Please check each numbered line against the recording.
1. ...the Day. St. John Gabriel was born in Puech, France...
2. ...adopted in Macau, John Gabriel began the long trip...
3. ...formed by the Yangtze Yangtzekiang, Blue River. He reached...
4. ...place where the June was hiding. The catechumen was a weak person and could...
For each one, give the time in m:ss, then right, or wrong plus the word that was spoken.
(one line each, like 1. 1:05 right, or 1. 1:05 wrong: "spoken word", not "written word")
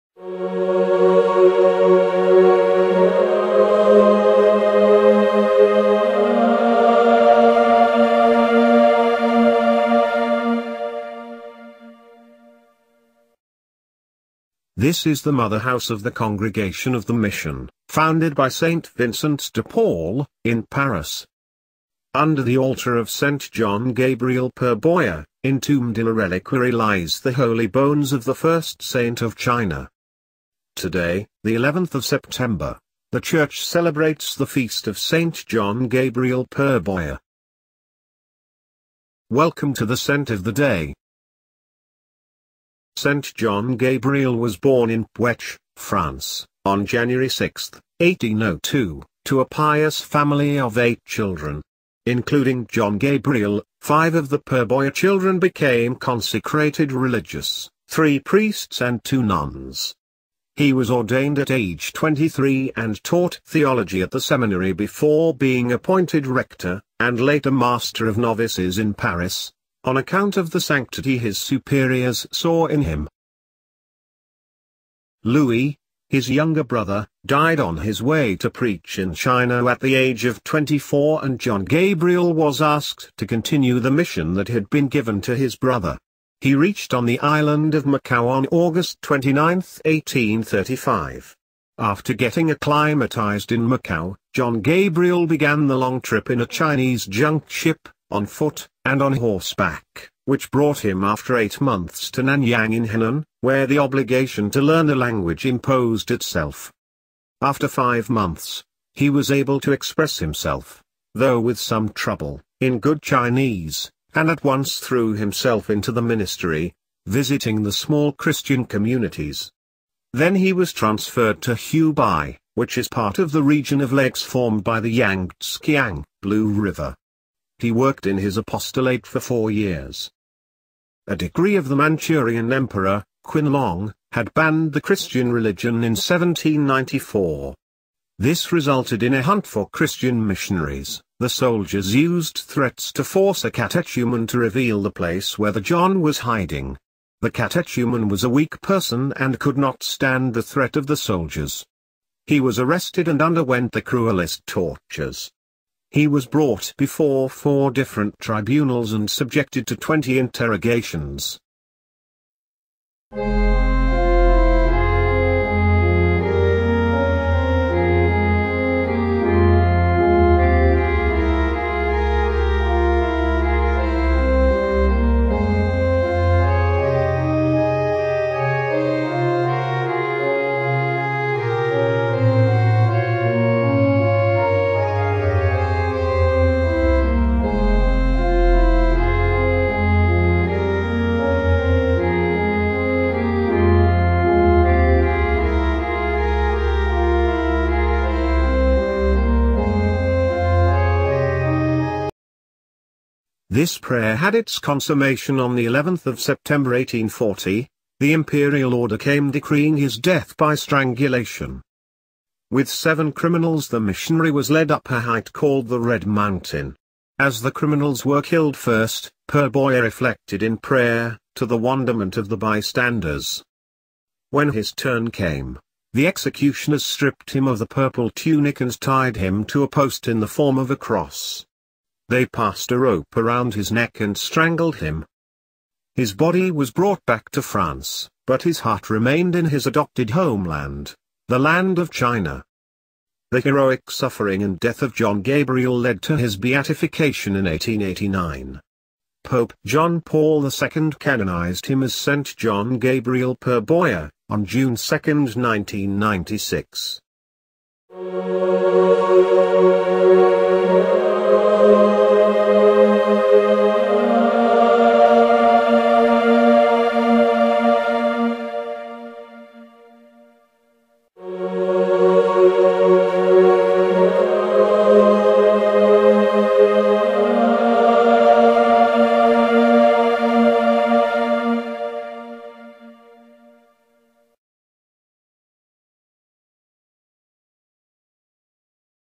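1. 0:40 right
2. 1:32 wrong: "acclimatized", not "adopted"
3. 2:04 wrong: "worked", not "reached"
4. 2:24 wrong: "John", not "June".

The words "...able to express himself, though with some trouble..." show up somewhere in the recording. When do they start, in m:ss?
1:49.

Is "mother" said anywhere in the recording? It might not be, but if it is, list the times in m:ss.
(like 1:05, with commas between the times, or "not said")
0:15.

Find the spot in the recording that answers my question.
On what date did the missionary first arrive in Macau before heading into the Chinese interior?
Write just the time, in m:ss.
1:28.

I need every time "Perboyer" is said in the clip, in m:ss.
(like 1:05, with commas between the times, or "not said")
0:24, 0:36, 0:54, 3:39, 4:13.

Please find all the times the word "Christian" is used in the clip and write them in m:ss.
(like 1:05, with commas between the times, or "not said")
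1:58, 2:14, 2:19.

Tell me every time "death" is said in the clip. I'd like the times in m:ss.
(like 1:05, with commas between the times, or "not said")
3:29, 4:04.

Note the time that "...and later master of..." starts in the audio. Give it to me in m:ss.
1:06.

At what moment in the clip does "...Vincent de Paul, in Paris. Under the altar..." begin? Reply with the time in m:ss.
0:18.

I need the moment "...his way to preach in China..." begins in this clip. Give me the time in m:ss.
1:17.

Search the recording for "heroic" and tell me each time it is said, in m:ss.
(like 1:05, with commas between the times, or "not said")
4:03.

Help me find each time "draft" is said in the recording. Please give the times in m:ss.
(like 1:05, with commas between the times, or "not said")
not said.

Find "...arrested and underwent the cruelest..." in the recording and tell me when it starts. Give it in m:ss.
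2:32.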